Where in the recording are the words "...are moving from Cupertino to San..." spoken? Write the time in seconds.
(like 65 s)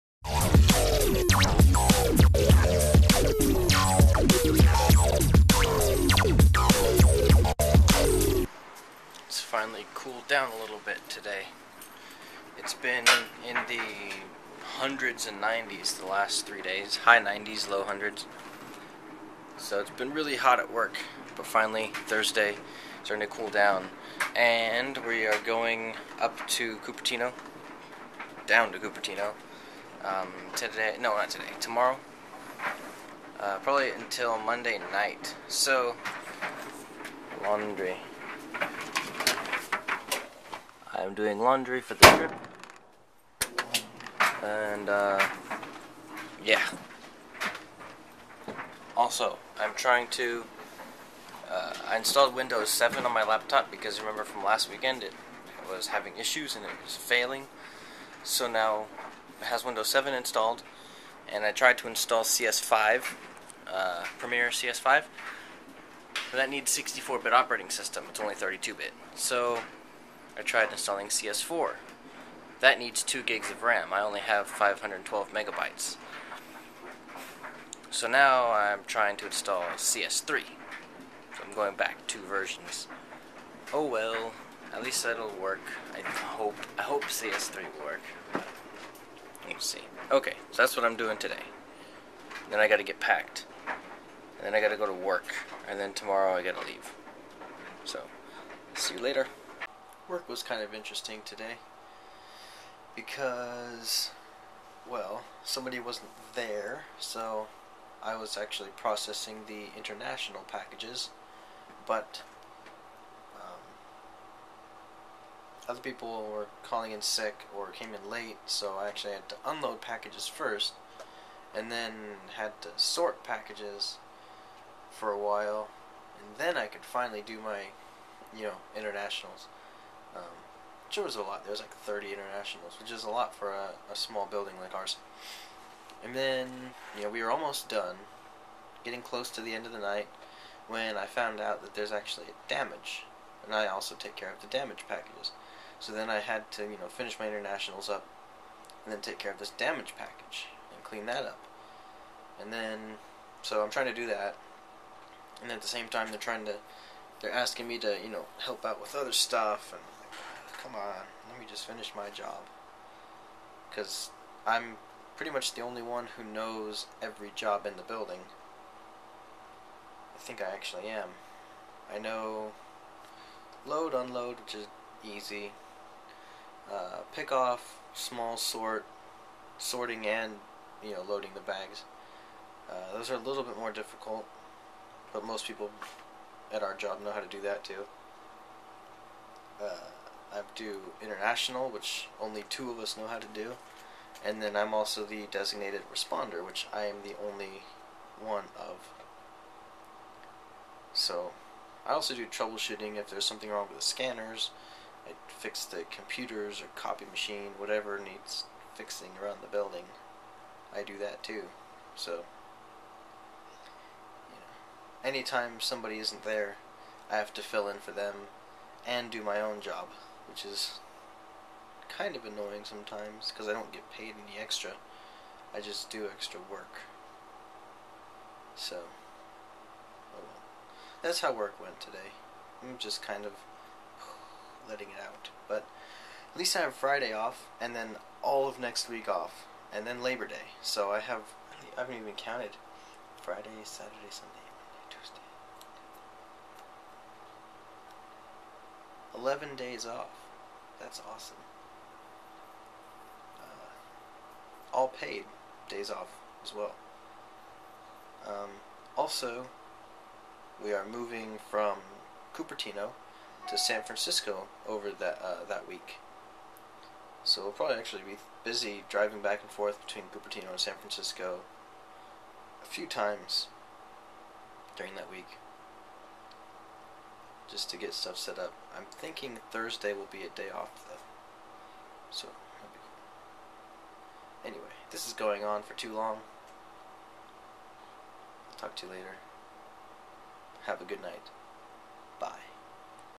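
260 s.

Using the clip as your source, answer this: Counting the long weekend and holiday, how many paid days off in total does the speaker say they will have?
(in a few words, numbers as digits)
11.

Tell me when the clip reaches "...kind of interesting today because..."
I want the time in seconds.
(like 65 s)
100 s.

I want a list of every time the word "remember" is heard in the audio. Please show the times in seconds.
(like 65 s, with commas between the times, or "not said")
53 s.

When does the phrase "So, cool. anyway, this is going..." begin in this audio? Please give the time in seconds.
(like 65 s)
282 s.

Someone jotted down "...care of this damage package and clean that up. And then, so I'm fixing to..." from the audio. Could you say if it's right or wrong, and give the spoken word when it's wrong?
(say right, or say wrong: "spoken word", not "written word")
wrong: "trying", not "fixing".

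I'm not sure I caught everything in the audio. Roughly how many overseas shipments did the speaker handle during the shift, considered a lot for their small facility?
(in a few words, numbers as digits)
30.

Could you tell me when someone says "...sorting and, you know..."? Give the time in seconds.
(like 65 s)
179 s.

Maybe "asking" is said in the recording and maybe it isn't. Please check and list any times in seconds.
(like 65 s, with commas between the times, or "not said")
157 s.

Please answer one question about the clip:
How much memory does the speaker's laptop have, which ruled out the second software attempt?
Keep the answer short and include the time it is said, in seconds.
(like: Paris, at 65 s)
512 megabytes, at 74 s.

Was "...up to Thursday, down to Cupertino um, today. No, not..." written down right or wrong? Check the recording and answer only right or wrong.
wrong.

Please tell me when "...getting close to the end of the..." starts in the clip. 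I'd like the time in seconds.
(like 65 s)
138 s.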